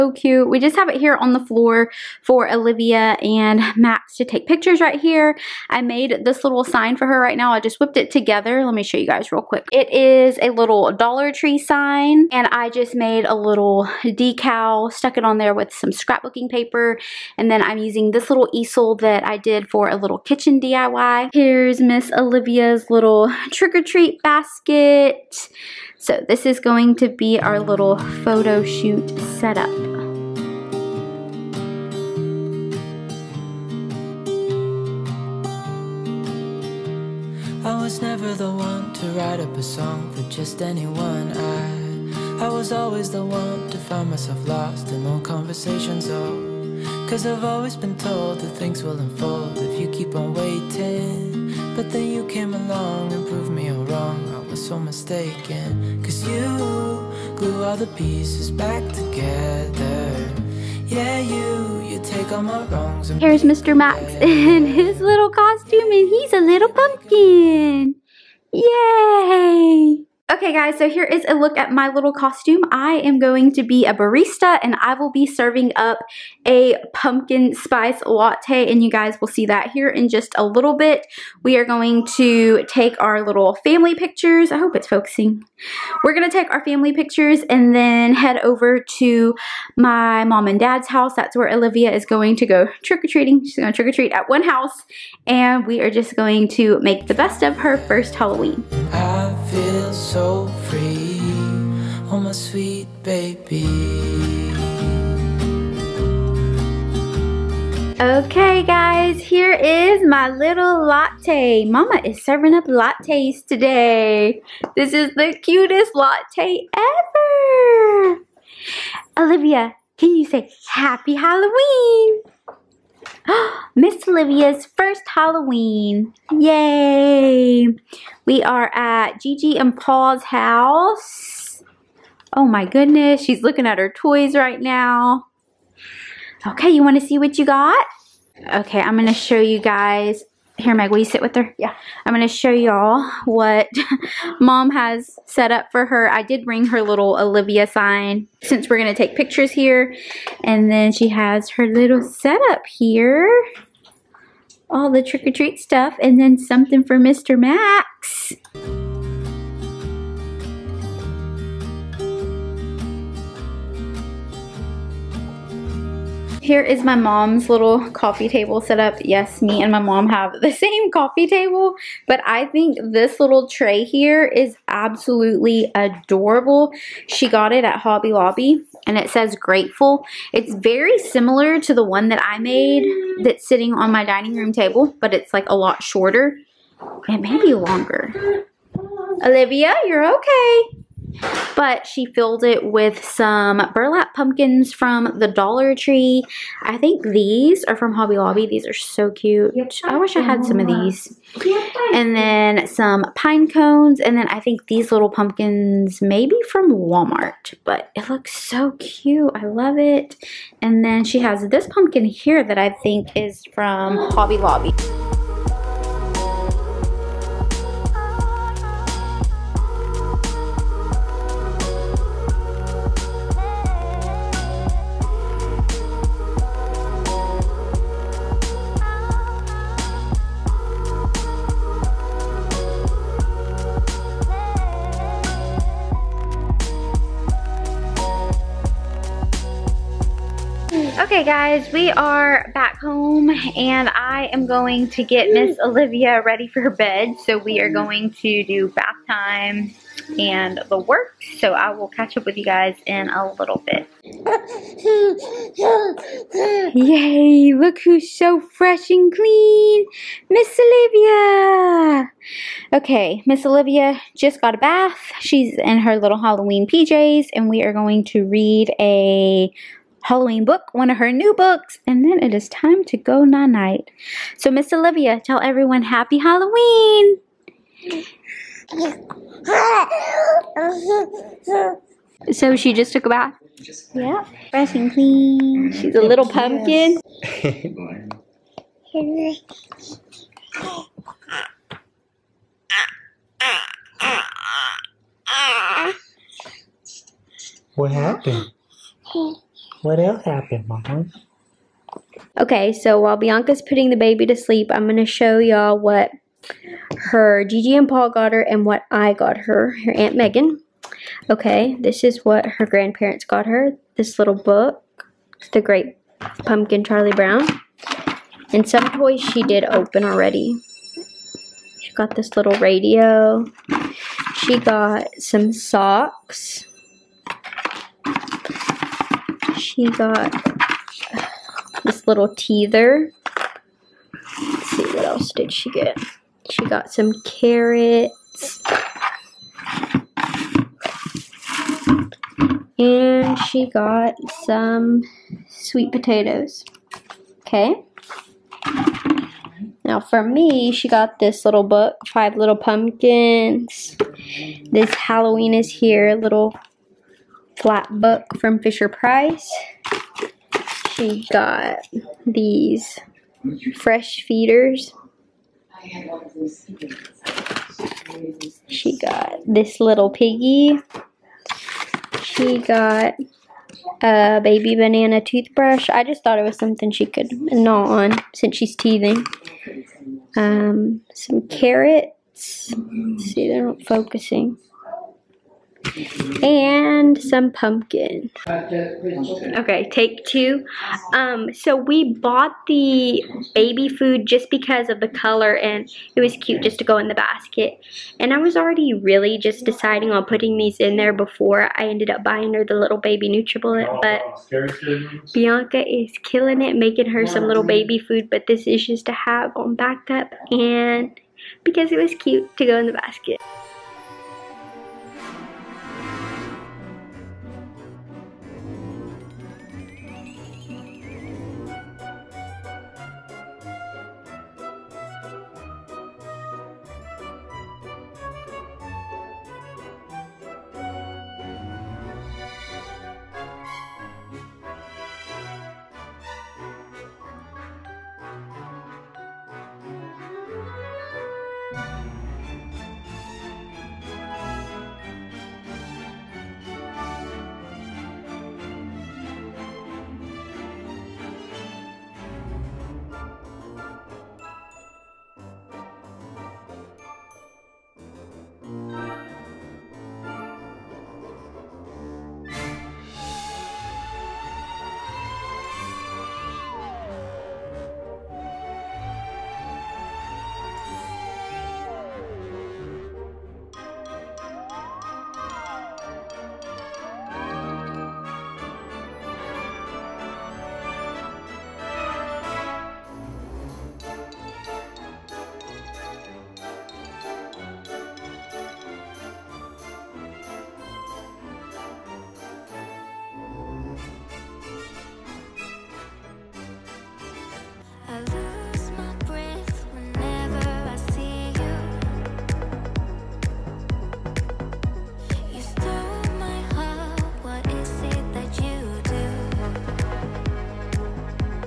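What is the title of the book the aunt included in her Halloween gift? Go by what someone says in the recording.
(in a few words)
Five Little Pumpkins.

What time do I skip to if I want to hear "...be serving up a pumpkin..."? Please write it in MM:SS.
01:15.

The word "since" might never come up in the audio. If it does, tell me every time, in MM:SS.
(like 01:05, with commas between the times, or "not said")
02:28, 06:18.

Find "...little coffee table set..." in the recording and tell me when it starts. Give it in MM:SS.
02:47.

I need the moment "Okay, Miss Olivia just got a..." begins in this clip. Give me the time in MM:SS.
04:22.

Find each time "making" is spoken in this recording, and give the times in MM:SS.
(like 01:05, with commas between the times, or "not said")
06:46.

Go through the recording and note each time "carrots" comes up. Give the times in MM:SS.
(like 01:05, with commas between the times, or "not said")
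05:37, 06:21.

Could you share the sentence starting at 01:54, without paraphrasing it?
This is the cutest latte ever.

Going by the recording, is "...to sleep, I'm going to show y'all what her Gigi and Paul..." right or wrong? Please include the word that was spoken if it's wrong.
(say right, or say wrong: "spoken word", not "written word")
right.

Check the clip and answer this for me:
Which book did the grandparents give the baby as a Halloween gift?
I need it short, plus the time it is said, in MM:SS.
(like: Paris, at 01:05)
The Great Pumpkin Charlie Brown, at 05:15.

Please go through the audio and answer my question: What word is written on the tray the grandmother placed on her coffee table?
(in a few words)
Grateful.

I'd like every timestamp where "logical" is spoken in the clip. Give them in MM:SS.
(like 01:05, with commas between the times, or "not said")
not said.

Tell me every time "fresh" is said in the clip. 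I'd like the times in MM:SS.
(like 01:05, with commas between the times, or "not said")
04:18, 04:44, 06:03.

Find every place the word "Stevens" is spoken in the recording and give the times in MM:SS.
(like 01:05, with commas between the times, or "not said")
not said.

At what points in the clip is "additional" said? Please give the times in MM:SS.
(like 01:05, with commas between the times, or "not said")
not said.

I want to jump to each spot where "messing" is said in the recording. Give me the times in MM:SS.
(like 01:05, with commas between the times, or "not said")
not said.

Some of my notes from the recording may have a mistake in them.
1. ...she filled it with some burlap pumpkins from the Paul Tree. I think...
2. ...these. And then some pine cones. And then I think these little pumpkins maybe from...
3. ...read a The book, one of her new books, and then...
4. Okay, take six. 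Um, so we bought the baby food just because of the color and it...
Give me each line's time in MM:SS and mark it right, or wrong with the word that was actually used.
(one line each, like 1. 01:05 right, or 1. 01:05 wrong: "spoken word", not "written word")
1. 03:11 wrong: "Dollar", not "Paul"
2. 03:20 right
3. 04:28 wrong: "Halloween", not "The"
4. 06:28 wrong: "two", not "six".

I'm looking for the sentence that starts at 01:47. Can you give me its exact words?
Okay guys, here is my little latte.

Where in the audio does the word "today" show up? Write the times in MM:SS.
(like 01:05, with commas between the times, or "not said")
01:53.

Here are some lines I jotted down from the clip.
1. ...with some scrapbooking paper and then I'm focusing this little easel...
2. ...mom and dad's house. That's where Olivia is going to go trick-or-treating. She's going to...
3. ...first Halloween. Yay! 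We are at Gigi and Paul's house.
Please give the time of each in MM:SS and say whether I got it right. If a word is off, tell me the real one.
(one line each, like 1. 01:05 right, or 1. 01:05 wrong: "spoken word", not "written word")
1. 00:15 wrong: "using", not "focusing"
2. 01:30 right
3. 02:04 right.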